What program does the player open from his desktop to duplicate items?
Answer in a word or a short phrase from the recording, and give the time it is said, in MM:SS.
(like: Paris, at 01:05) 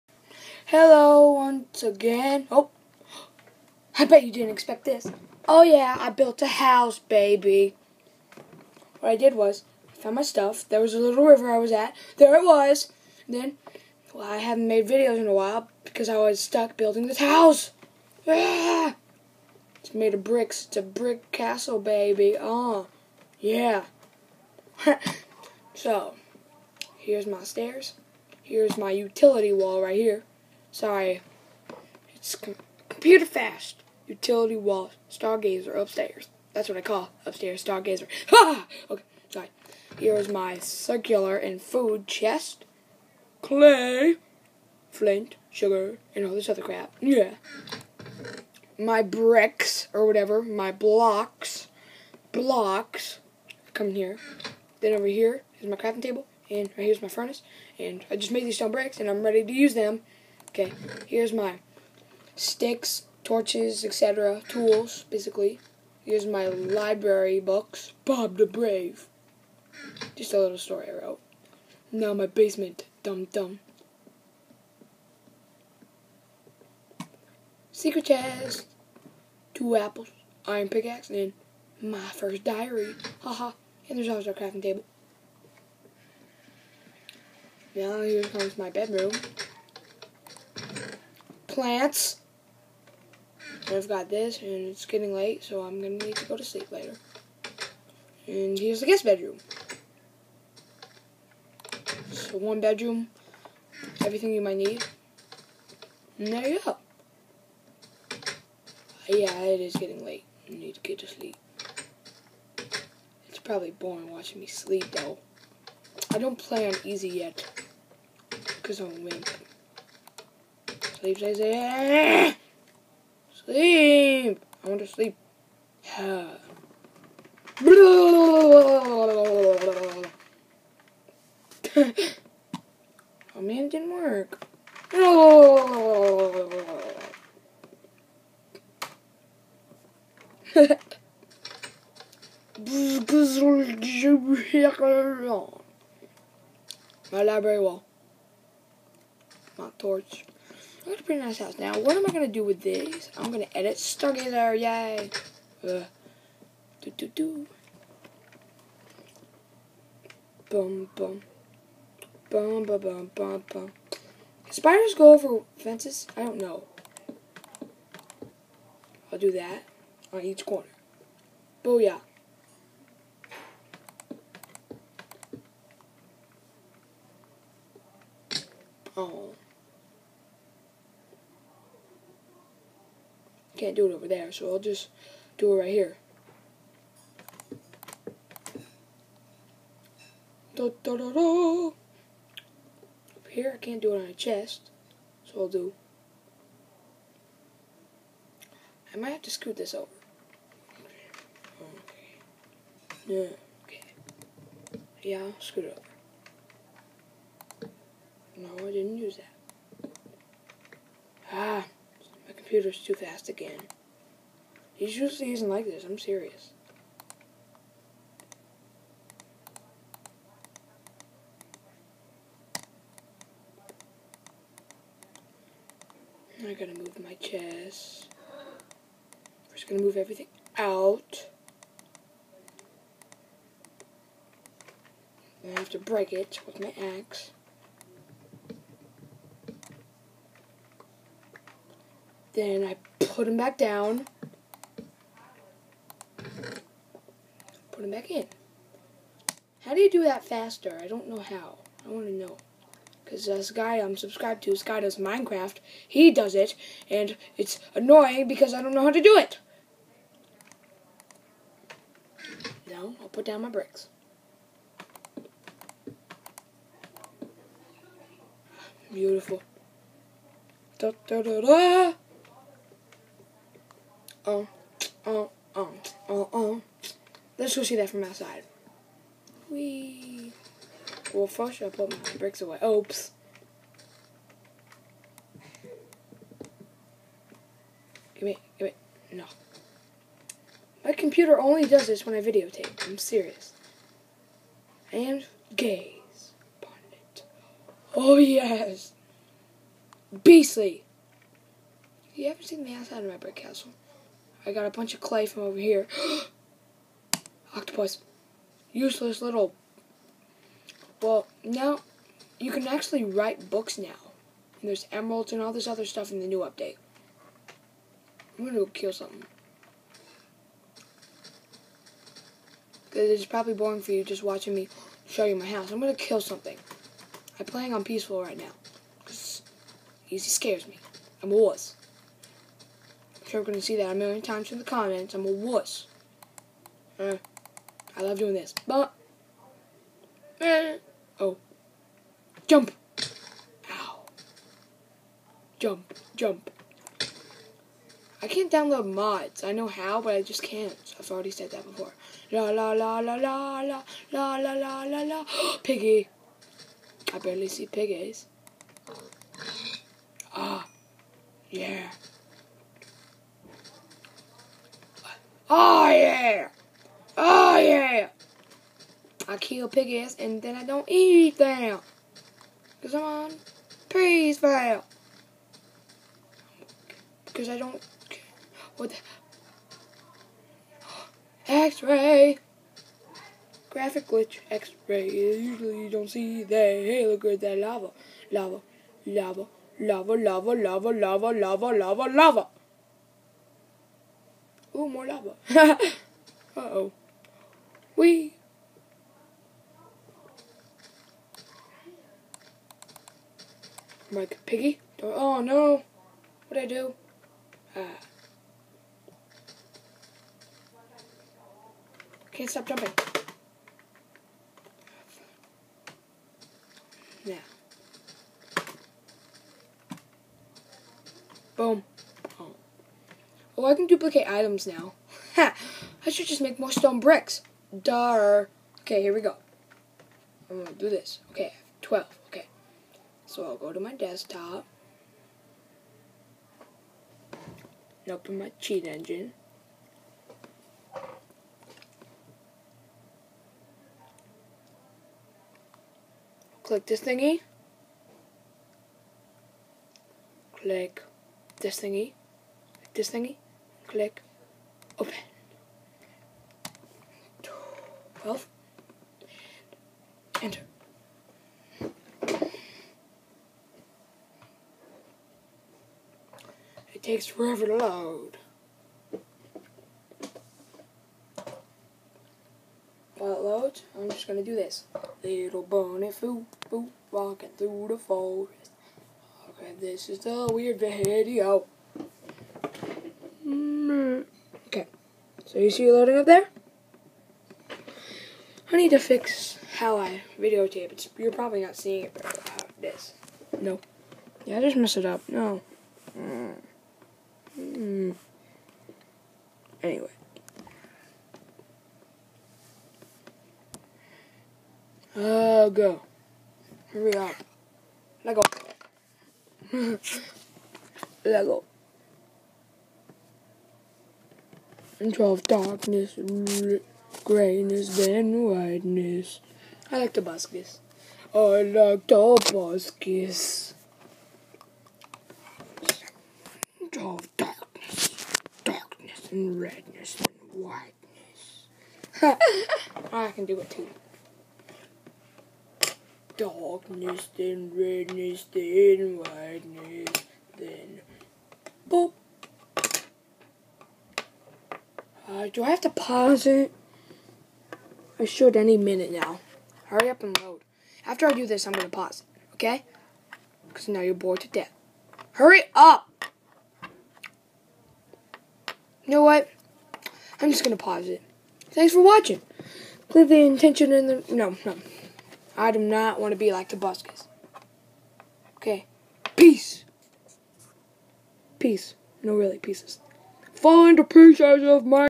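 Cheat engine, at 07:18.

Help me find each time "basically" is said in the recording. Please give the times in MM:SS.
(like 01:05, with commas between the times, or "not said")
01:05.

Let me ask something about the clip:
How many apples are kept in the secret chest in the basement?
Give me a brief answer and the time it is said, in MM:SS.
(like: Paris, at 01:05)
2, at 01:19.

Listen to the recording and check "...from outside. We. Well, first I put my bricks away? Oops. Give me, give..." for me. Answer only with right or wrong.
right.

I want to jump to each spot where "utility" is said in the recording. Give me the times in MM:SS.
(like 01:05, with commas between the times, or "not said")
00:28, 00:34.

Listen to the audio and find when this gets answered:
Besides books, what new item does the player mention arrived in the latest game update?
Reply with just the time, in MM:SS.
05:14.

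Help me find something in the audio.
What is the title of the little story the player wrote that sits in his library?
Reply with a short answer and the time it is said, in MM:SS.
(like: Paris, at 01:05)
Bob the Brave, at 01:08.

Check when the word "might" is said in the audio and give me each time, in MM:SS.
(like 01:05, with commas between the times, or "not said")
01:44, 03:18.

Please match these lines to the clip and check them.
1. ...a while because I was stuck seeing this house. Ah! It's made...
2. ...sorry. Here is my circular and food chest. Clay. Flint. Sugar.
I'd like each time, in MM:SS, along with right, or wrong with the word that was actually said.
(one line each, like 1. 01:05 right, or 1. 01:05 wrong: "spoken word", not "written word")
1. 00:15 wrong: "building", not "seeing"
2. 00:39 right.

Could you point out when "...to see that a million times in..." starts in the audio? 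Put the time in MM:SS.
05:33.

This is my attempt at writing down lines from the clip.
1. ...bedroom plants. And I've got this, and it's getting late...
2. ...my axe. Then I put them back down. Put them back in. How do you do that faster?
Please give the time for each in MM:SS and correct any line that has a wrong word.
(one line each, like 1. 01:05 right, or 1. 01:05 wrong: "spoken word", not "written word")
1. 01:28 right
2. 03:56 right.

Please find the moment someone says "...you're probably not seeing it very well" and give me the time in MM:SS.
08:11.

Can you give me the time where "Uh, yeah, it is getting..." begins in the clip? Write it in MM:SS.
01:46.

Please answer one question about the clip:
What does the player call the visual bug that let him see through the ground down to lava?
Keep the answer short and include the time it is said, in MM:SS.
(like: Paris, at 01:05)
Graphic glitch, X ray, at 06:23.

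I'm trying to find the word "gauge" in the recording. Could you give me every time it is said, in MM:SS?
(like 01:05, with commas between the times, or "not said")
not said.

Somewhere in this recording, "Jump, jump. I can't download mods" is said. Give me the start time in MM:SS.
05:45.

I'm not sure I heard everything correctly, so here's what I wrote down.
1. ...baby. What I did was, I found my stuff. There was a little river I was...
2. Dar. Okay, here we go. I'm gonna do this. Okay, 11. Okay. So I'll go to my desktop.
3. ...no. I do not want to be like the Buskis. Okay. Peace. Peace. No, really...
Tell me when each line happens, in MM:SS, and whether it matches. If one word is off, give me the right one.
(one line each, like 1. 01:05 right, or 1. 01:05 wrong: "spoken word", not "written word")
1. 00:06 right
2. 07:07 wrong: "12", not "11"
3. 09:24 right.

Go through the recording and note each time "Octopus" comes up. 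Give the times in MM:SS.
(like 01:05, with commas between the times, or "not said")
05:07.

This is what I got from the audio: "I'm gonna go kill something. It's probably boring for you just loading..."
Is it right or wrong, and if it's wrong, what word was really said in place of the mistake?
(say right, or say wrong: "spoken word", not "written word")
wrong: "watching", not "loading".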